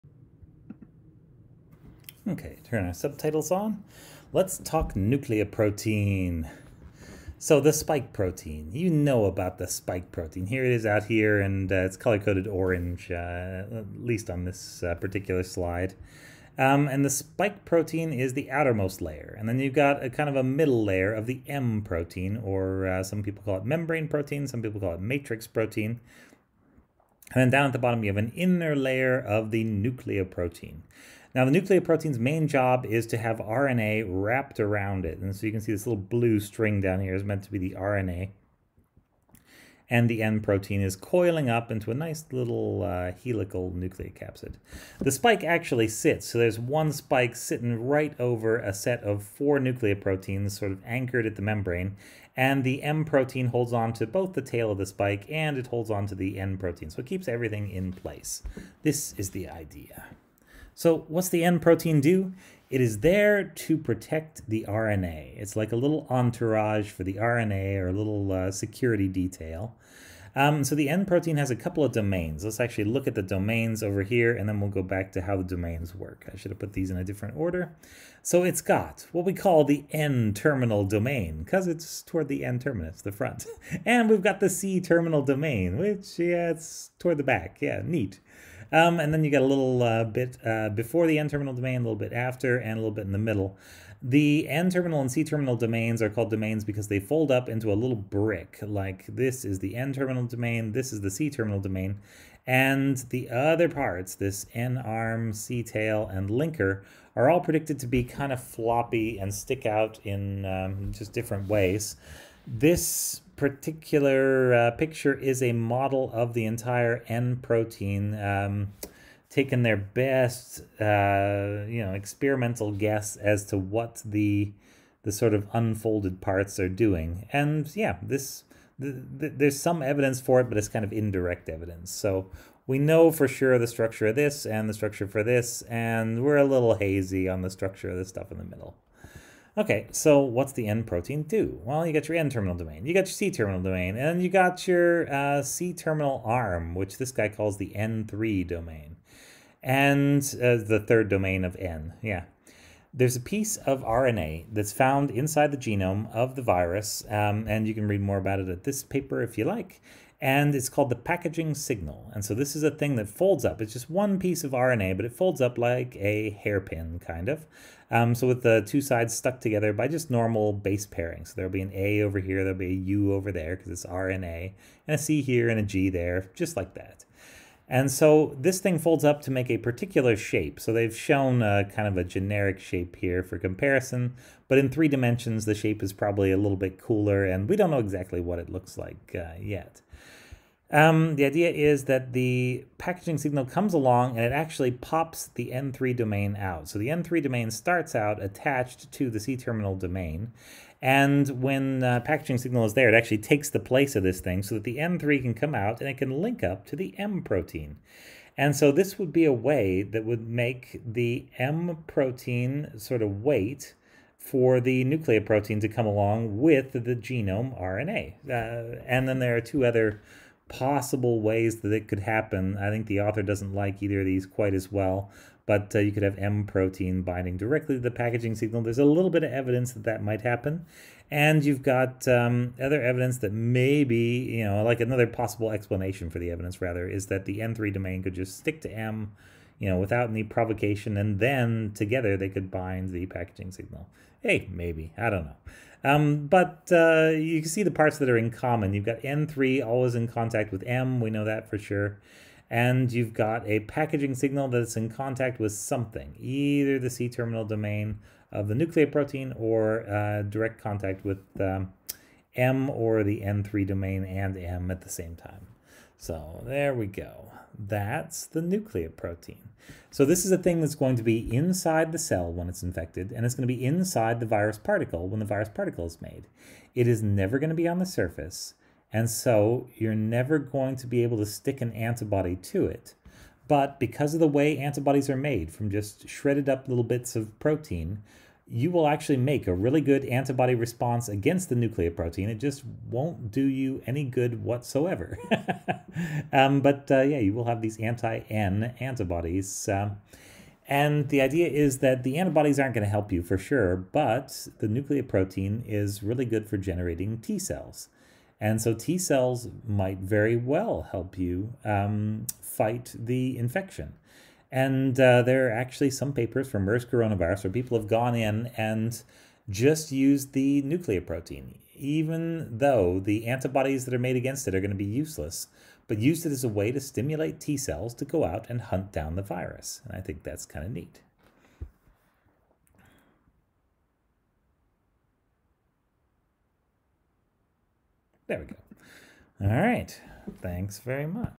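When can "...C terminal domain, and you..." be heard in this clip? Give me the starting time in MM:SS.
02:23.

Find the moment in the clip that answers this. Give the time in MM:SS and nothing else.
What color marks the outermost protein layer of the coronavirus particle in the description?
00:12.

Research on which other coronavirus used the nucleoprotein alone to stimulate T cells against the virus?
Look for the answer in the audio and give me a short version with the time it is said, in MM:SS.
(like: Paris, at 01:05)
MERS, at 05:16.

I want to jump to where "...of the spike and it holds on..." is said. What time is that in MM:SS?
00:54.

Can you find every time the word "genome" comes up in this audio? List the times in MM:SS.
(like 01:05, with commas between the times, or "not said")
02:35, 03:36.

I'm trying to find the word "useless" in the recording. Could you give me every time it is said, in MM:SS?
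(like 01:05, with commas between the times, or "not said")
05:24.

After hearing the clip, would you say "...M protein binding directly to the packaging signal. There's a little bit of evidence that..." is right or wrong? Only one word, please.
right.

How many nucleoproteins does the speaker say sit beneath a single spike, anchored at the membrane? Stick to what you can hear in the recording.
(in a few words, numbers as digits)
4.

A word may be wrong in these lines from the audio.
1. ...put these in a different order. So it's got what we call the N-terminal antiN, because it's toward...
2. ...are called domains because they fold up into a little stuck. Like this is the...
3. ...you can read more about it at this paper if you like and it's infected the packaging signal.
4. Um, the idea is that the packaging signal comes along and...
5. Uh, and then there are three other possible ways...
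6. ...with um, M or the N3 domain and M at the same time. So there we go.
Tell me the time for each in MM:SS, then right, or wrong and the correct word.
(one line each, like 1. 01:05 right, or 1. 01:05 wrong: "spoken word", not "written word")
1. 01:16 wrong: "domain", not "antiN"
2. 01:36 wrong: "brick", not "stuck"
3. 02:37 wrong: "called", not "infected"
4. 03:10 right
5. 03:38 wrong: "two", not "three"
6. 04:21 right.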